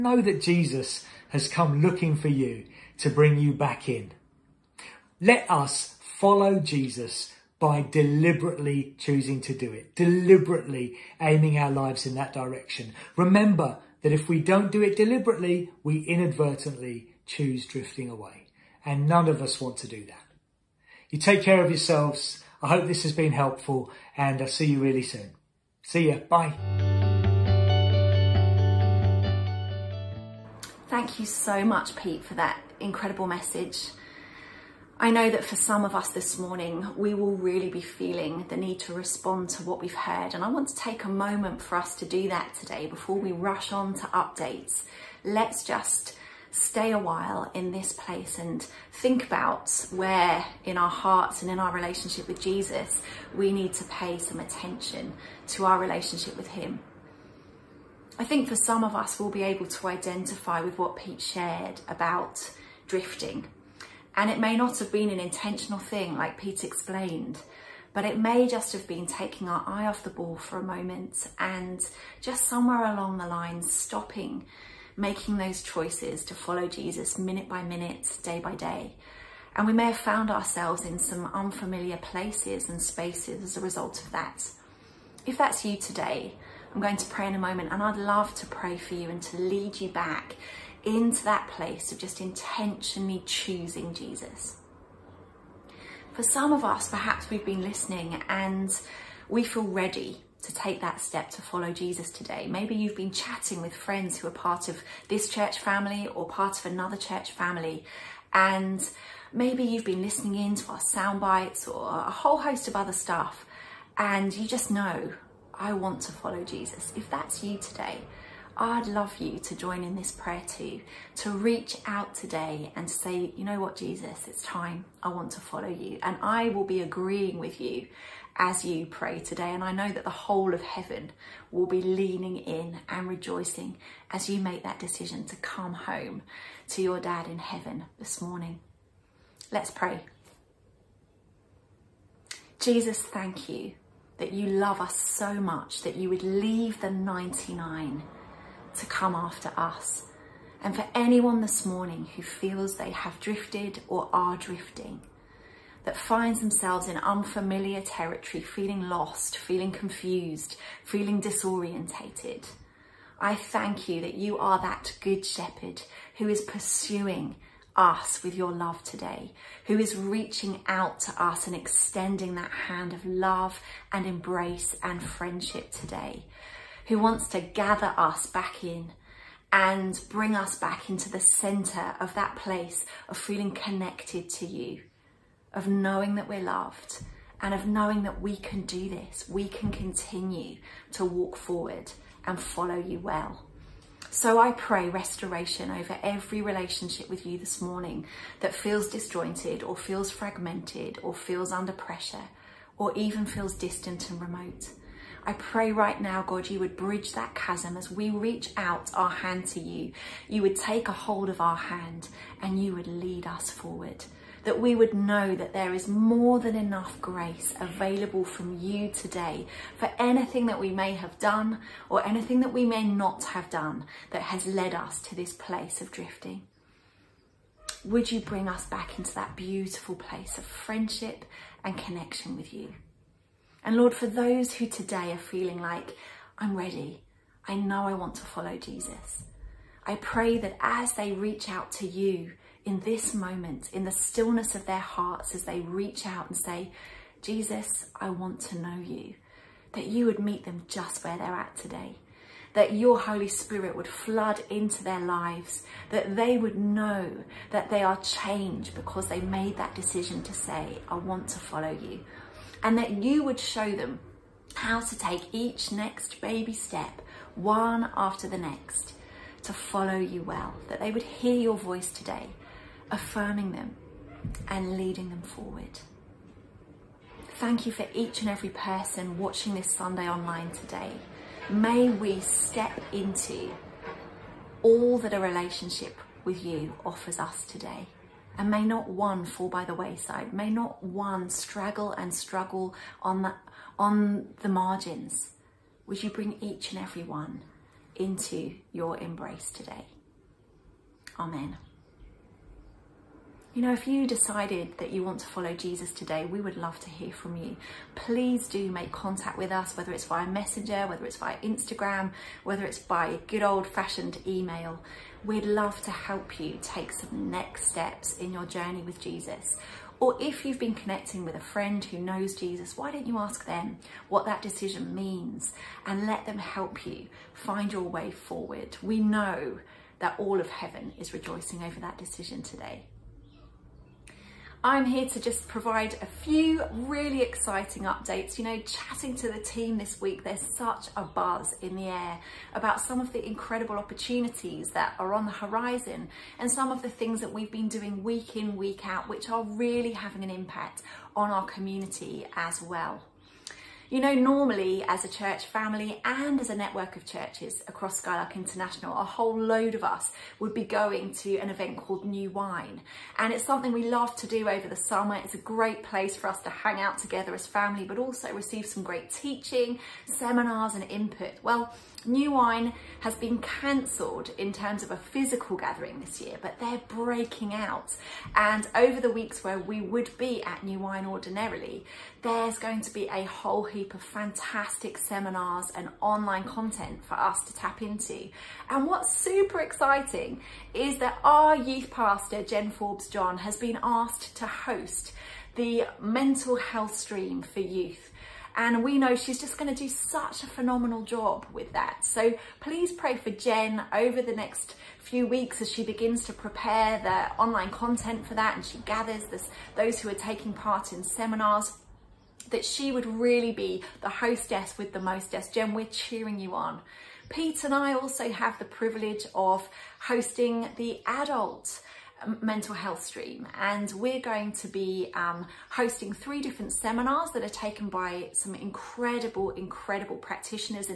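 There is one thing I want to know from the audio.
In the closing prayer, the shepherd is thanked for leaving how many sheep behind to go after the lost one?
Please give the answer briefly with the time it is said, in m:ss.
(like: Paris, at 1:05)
99, at 2:26.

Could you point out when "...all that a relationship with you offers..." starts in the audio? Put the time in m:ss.
4:44.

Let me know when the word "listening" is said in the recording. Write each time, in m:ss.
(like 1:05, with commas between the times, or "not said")
1:37, 1:50.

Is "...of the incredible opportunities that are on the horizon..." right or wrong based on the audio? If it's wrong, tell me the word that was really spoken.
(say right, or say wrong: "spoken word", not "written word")
right.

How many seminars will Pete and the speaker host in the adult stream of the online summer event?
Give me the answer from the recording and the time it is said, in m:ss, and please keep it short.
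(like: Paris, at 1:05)
3, at 7:06.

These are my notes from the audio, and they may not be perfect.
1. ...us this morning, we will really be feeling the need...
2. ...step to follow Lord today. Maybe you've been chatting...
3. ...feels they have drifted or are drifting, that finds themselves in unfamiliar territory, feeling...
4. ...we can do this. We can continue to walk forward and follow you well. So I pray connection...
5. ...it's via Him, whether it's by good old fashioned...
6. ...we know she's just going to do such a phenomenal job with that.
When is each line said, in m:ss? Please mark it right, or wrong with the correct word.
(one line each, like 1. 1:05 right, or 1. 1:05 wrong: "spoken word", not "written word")
1. 0:35 right
2. 1:41 wrong: "Jesus", not "Lord"
3. 2:32 right
4. 3:08 wrong: "restoration", not "connection"
5. 5:11 wrong: "Instagram", not "Him"
6. 6:38 right.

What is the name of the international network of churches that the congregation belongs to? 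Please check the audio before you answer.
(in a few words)
Skylark International.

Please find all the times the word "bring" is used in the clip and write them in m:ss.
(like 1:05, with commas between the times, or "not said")
0:03, 3:00, 3:48, 4:56.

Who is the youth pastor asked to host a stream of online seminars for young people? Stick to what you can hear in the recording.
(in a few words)
Jen Forbes John.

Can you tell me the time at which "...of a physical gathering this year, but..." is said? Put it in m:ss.
6:14.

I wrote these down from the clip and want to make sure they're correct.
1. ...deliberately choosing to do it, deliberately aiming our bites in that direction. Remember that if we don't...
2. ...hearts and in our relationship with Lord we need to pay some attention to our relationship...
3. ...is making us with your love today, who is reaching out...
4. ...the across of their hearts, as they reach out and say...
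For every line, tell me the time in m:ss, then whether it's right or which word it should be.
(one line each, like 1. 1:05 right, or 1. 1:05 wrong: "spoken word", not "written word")
1. 0:07 wrong: "lives", not "bites"
2. 0:50 wrong: "Jesus", not "Lord"
3. 2:46 wrong: "pursuing", not "making"
4. 4:03 wrong: "stillness", not "across".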